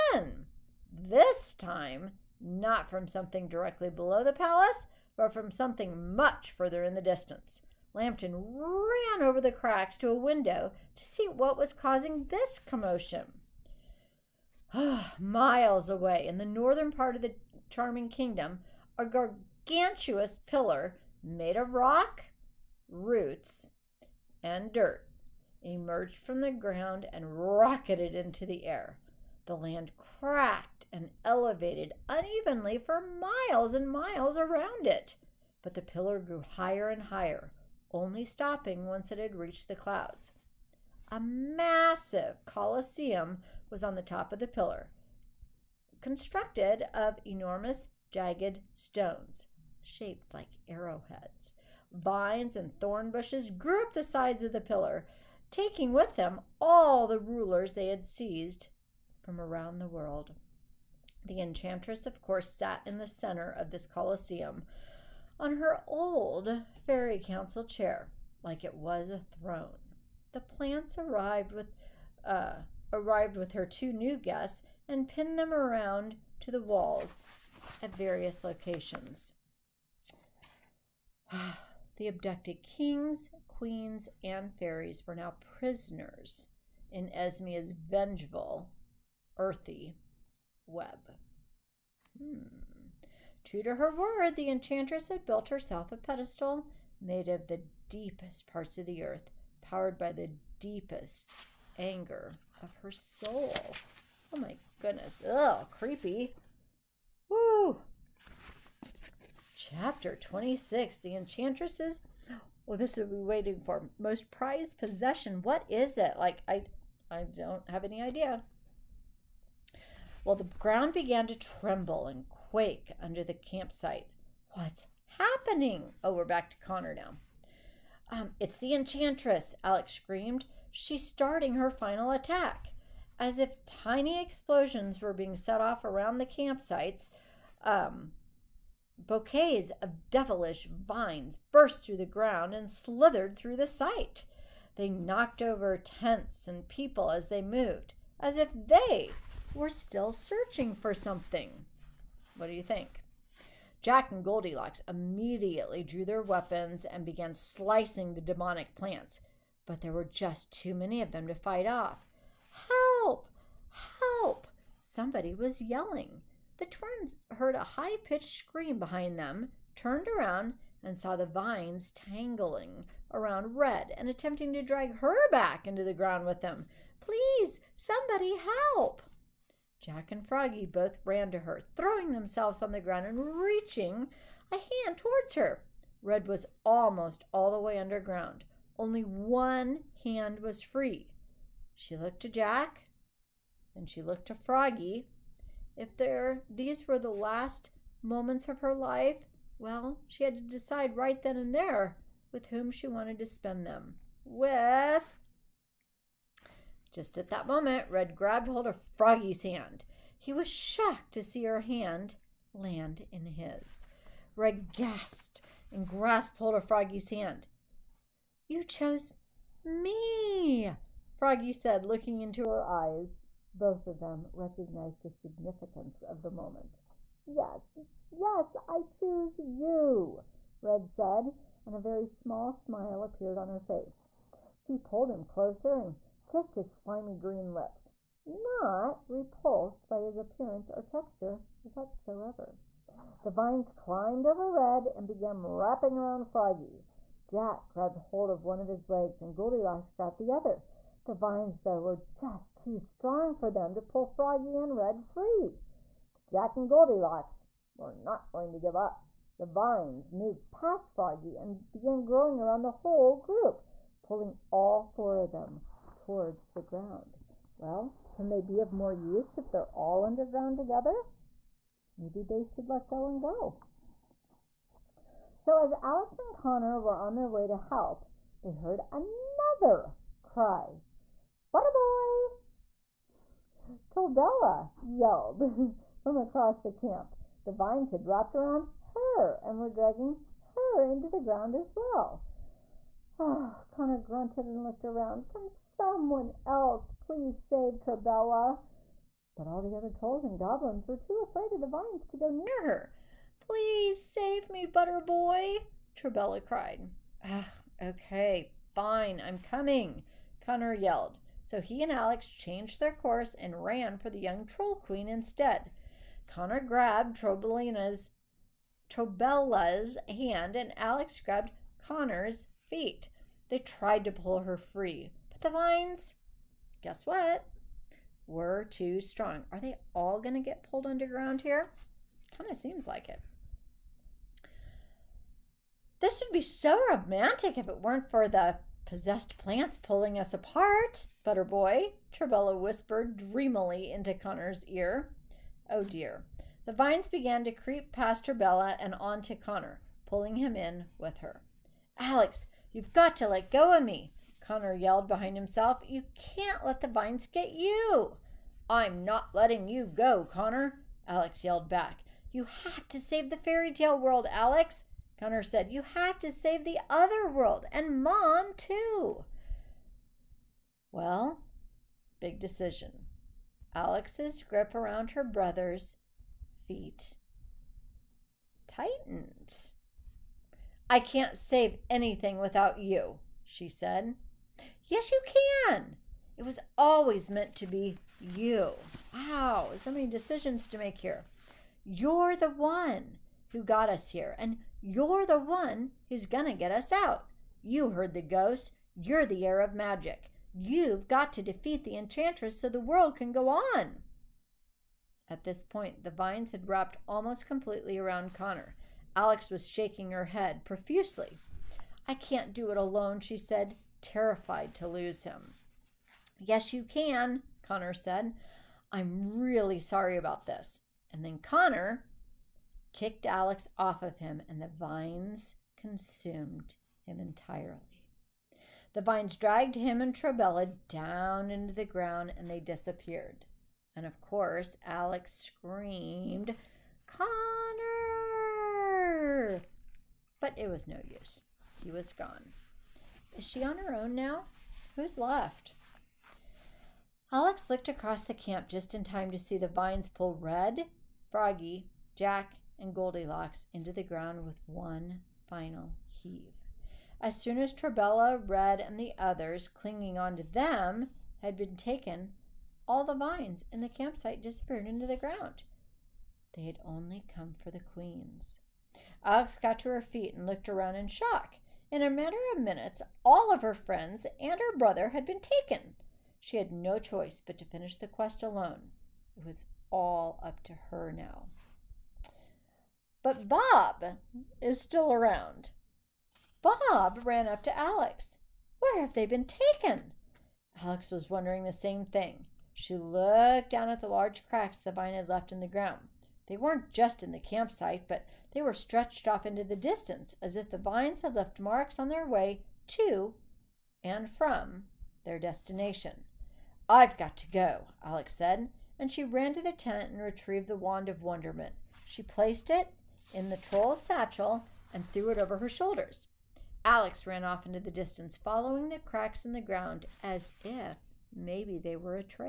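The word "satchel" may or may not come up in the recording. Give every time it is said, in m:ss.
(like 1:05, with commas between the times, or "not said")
8:34.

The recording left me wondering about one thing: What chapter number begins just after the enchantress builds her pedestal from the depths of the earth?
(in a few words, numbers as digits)
26.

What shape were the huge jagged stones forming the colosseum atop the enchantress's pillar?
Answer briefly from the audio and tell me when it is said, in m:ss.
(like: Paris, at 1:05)
Arrowheads, at 0:50.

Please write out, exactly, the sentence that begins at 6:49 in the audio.
Alex was shaking her head profusely.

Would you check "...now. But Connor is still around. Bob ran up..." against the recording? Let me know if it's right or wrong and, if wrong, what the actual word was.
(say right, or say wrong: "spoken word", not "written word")
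wrong: "Bob", not "Connor".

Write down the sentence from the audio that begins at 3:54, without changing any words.
She pulled him closer and kissed his slimy green lips, not repulsed by his appearance or texture whatsoever.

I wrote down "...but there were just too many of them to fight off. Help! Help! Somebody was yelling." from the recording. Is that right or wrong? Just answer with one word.
right.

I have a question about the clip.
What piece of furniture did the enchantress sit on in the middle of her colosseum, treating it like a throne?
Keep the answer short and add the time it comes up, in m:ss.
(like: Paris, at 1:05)
Her old fairy council chair, at 1:05.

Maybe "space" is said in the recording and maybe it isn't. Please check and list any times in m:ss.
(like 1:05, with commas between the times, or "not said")
not said.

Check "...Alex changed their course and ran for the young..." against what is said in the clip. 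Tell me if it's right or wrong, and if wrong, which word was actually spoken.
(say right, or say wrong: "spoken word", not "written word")
right.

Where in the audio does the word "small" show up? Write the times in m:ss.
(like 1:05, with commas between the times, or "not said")
3:52.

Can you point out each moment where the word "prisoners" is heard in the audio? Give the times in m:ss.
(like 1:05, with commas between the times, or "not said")
1:25.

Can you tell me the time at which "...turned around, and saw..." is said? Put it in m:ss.
2:49.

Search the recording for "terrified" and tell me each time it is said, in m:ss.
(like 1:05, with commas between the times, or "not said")
6:54.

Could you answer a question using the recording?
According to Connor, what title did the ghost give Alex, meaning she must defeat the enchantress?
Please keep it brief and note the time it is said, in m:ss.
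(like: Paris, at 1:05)
The heir of magic, at 6:39.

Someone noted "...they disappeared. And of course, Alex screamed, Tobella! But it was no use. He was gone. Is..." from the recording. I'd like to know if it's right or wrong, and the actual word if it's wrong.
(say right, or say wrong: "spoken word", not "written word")
wrong: "Connor", not "Tobella".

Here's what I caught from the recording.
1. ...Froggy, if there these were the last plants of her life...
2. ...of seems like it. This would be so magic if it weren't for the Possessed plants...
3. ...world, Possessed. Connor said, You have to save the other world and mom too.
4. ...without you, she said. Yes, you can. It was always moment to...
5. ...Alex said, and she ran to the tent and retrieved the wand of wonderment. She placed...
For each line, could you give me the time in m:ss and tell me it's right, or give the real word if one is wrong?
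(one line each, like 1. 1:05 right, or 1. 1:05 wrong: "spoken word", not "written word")
1. 3:14 wrong: "moments", not "plants"
2. 5:32 wrong: "romantic", not "magic"
3. 6:03 wrong: "Alex", not "Possessed"
4. 6:22 wrong: "meant", not "moment"
5. 8:28 right.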